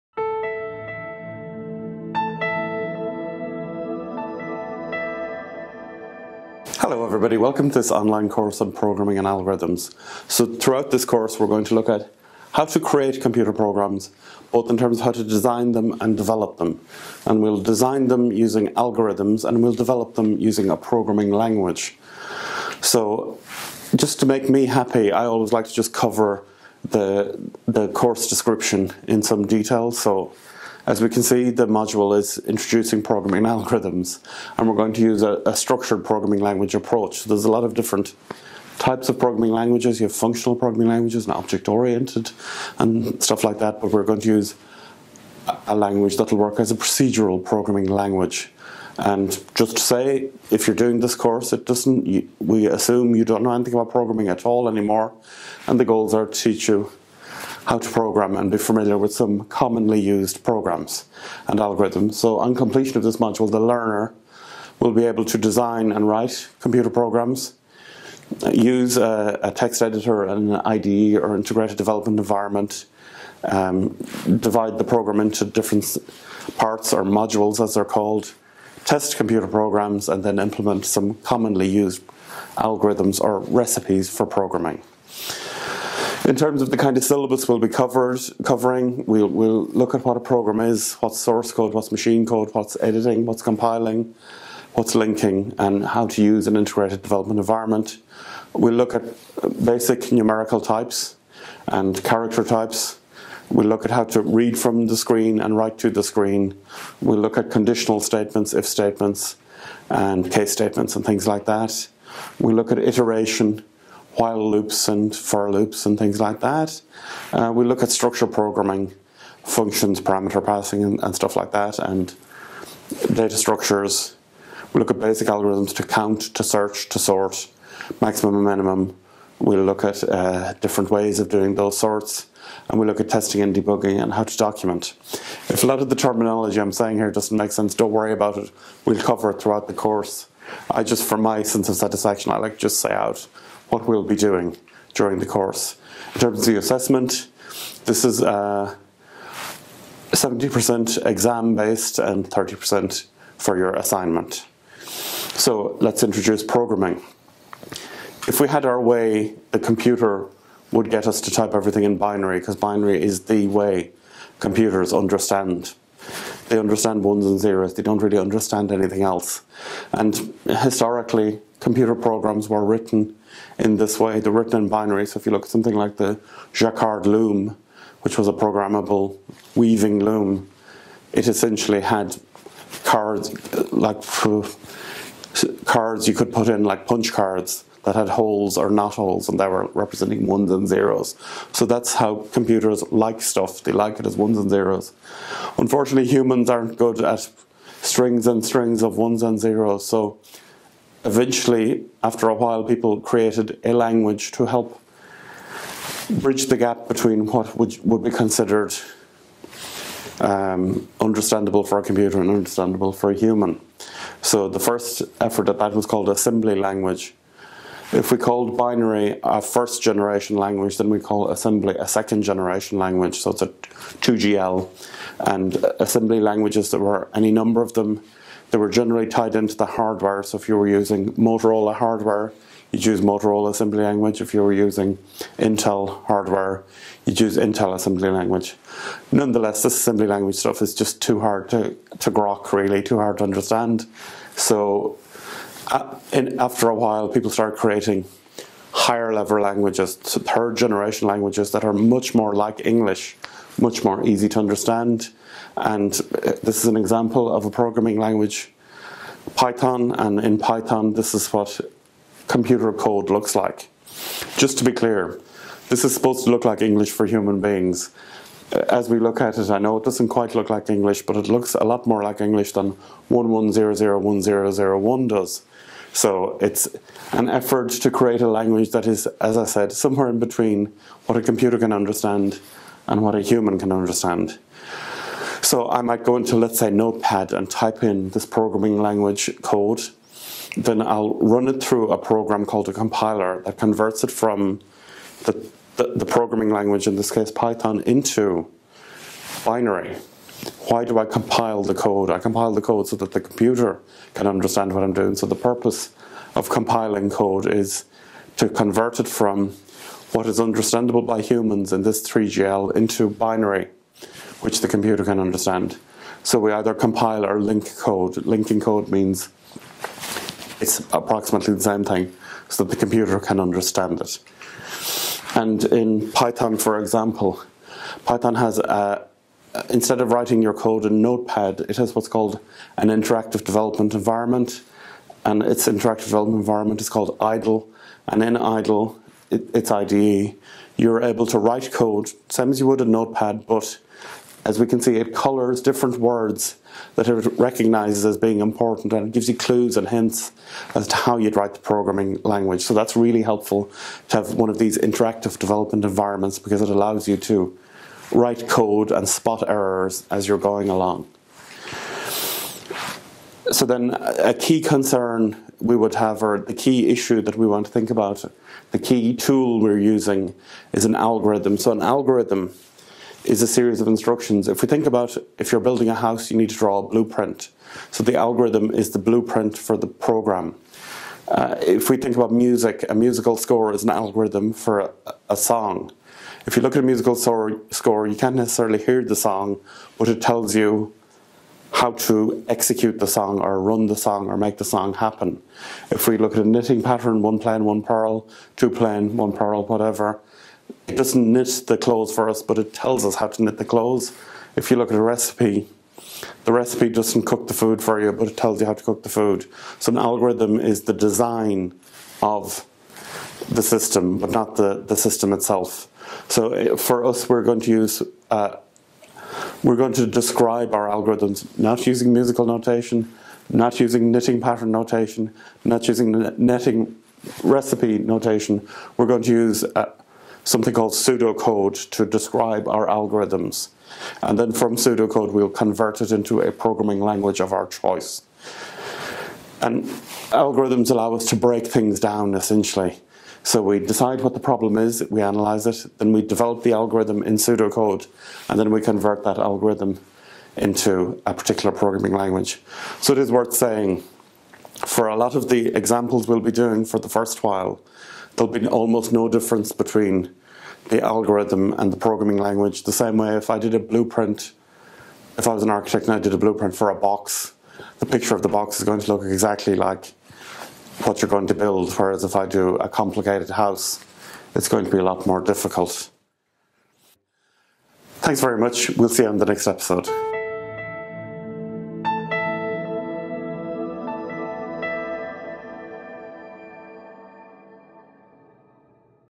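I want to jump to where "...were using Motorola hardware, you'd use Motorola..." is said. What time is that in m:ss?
3:50.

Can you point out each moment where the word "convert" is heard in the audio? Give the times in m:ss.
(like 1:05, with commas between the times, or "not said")
4:53, 5:08, 7:15, 7:28.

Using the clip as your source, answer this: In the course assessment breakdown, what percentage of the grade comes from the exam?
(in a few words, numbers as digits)
70%.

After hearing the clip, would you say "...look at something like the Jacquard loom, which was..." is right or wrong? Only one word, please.
right.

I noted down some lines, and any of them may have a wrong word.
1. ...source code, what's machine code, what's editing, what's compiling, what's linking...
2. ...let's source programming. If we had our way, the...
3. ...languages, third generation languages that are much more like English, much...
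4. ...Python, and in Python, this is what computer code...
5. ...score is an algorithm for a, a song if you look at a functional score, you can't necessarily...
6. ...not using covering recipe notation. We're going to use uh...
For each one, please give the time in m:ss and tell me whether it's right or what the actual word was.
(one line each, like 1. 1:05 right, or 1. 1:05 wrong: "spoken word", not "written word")
1. 1:31 right
2. 2:35 wrong: "introduce", not "source"
3. 4:09 right
4. 4:19 right
5. 6:23 wrong: "musical", not "functional"
6. 7:05 wrong: "netting", not "covering".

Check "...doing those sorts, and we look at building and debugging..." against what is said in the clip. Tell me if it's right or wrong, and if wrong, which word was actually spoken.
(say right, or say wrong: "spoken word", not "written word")
wrong: "testing", not "building".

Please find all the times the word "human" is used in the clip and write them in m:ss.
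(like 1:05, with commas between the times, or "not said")
3:16, 3:33, 4:27, 4:43, 5:11.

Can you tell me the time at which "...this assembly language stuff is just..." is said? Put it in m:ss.
3:59.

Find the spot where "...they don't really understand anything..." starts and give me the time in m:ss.
2:47.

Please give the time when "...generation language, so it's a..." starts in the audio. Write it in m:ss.
3:42.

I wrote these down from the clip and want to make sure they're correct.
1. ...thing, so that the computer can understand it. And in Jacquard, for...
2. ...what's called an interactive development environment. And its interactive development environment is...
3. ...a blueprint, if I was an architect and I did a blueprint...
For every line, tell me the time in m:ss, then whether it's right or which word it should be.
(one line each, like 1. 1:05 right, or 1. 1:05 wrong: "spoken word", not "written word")
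1. 5:21 wrong: "Python", not "Jacquard"
2. 5:31 right
3. 7:43 right.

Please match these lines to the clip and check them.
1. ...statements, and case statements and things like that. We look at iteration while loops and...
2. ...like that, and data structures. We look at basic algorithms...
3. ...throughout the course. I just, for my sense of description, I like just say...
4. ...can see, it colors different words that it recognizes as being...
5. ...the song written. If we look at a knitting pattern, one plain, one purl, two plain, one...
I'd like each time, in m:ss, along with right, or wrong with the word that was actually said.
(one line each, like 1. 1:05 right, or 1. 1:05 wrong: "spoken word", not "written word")
1. 1:48 right
2. 2:01 right
3. 2:19 wrong: "satisfaction", not "description"
4. 5:44 right
5. 6:34 wrong: "happen", not "written".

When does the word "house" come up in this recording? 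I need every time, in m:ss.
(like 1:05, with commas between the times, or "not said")
6:15, 7:53.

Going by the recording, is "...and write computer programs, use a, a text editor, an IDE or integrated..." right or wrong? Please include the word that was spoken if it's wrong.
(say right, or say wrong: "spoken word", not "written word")
right.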